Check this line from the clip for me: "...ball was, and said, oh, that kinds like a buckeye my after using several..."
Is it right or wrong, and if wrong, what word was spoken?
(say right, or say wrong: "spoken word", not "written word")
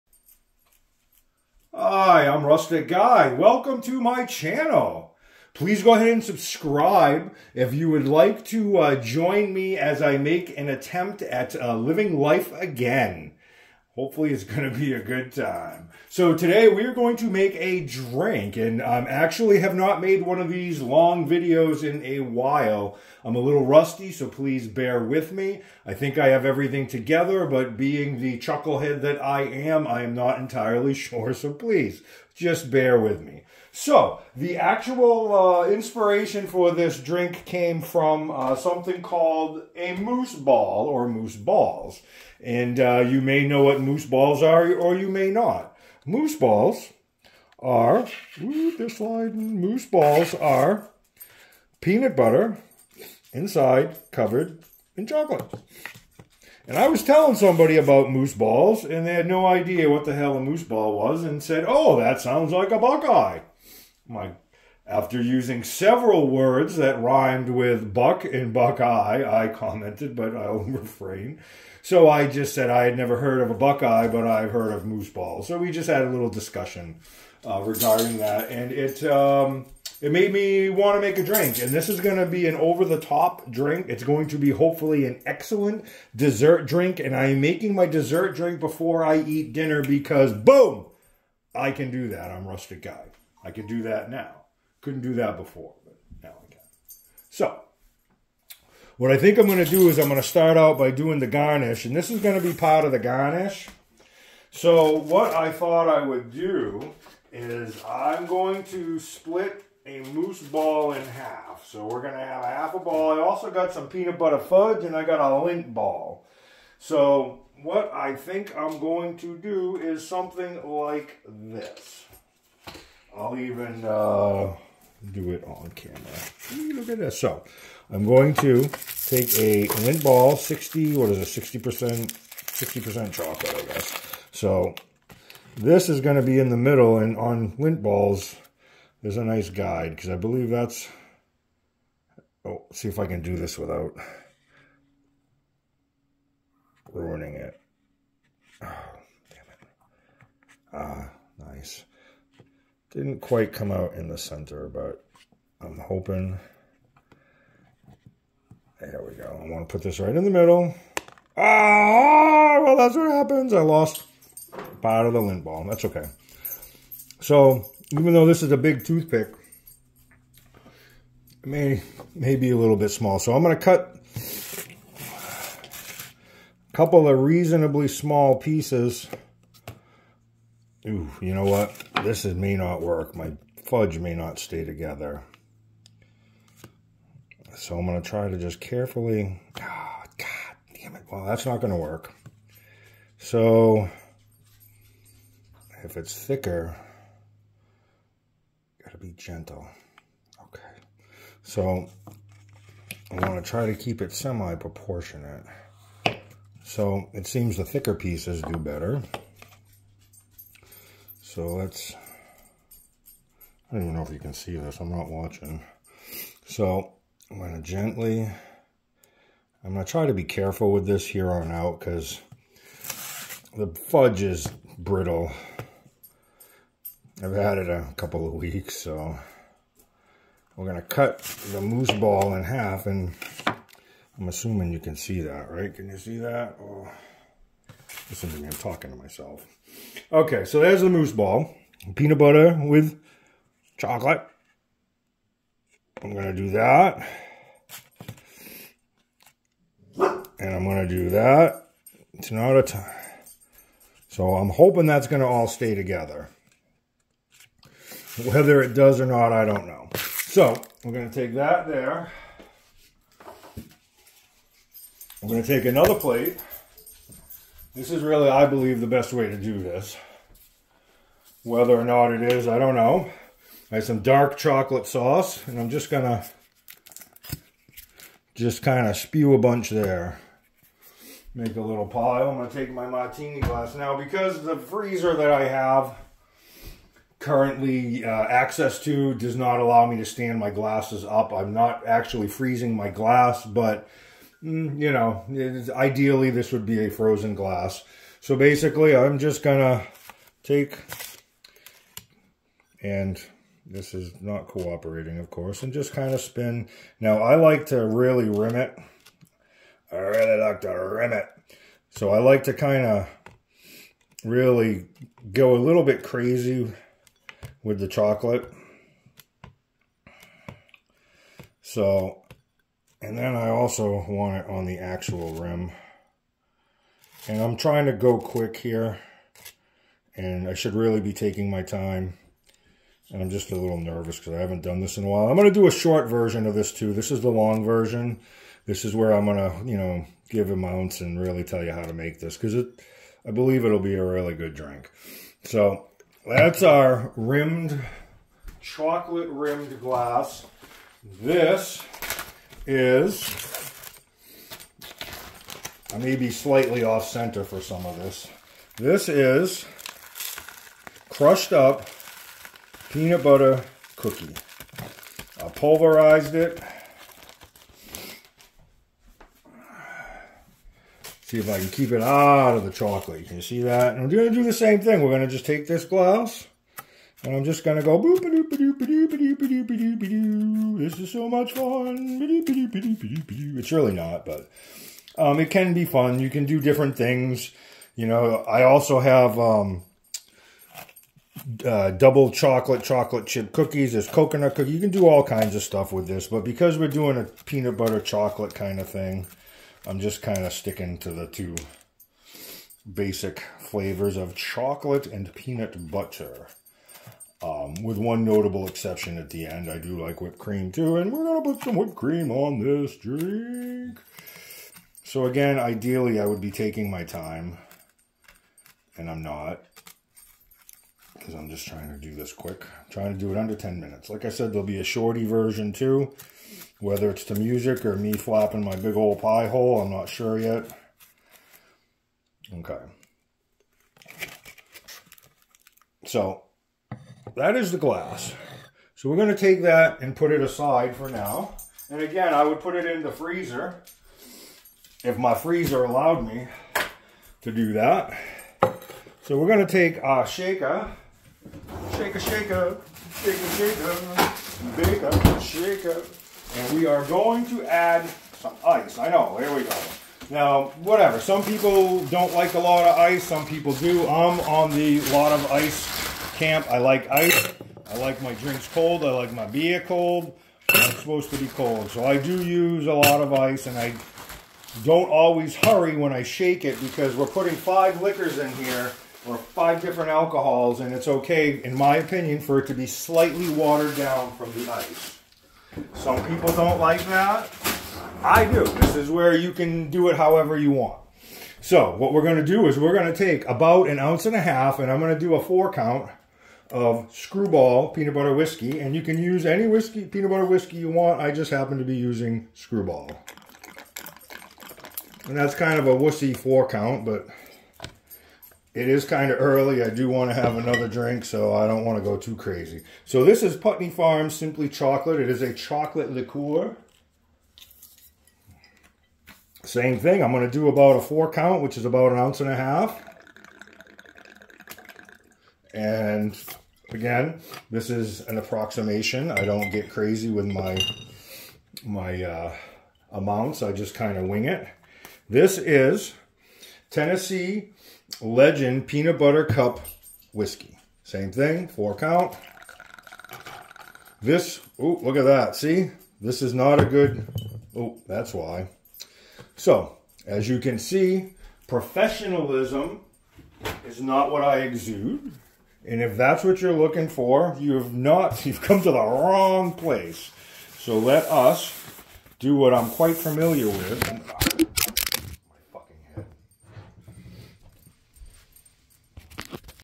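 wrong: "sounds", not "kinds".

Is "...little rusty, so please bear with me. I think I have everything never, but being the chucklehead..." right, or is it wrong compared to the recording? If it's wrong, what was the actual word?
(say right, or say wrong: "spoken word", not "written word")
wrong: "together", not "never".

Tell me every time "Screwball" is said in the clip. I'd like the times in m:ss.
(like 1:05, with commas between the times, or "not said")
8:17, 8:22.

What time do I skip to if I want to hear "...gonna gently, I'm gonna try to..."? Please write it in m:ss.
3:37.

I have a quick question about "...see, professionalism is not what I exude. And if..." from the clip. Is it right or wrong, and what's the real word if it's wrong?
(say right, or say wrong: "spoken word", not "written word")
right.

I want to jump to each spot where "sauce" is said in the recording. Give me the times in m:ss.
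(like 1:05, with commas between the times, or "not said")
4:34.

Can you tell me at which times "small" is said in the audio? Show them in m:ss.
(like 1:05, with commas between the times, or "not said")
2:52, 2:57.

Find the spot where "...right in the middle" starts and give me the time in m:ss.
2:40.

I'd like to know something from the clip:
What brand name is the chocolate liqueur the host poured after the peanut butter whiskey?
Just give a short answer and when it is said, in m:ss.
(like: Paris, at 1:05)
Putney Farm, at 8:33.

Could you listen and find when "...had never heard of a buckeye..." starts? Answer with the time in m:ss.
1:12.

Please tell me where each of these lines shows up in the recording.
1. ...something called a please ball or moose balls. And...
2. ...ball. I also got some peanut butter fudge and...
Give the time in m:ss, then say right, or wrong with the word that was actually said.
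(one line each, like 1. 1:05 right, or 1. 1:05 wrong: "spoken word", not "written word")
1. 0:38 wrong: "moose", not "please"
2. 1:52 right.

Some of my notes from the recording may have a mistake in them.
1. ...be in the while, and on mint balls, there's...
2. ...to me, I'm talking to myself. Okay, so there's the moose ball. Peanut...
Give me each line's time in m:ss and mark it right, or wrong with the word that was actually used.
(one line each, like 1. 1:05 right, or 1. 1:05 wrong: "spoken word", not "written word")
1. 2:16 wrong: "middle", not "while"
2. 3:58 right.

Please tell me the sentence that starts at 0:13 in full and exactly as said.
Hopefully, it's going to be a good time.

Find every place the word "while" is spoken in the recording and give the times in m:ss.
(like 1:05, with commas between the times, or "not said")
0:22, 5:35.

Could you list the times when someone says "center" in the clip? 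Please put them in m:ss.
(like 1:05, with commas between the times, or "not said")
2:34, 5:57.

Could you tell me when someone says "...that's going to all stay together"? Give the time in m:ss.
4:14.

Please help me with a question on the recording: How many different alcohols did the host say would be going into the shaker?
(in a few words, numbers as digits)
5.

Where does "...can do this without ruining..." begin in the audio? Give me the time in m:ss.
2:23.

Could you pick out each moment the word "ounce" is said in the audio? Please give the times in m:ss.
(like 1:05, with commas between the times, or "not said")
8:13, 8:42.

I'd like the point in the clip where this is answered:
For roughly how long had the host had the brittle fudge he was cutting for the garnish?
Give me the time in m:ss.
3:47.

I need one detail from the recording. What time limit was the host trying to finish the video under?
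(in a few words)
10 minutes.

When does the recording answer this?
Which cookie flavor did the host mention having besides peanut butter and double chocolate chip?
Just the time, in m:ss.
6:34.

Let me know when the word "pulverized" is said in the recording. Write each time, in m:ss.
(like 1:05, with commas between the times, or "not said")
6:05.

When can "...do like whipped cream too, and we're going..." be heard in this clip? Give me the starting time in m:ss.
6:49.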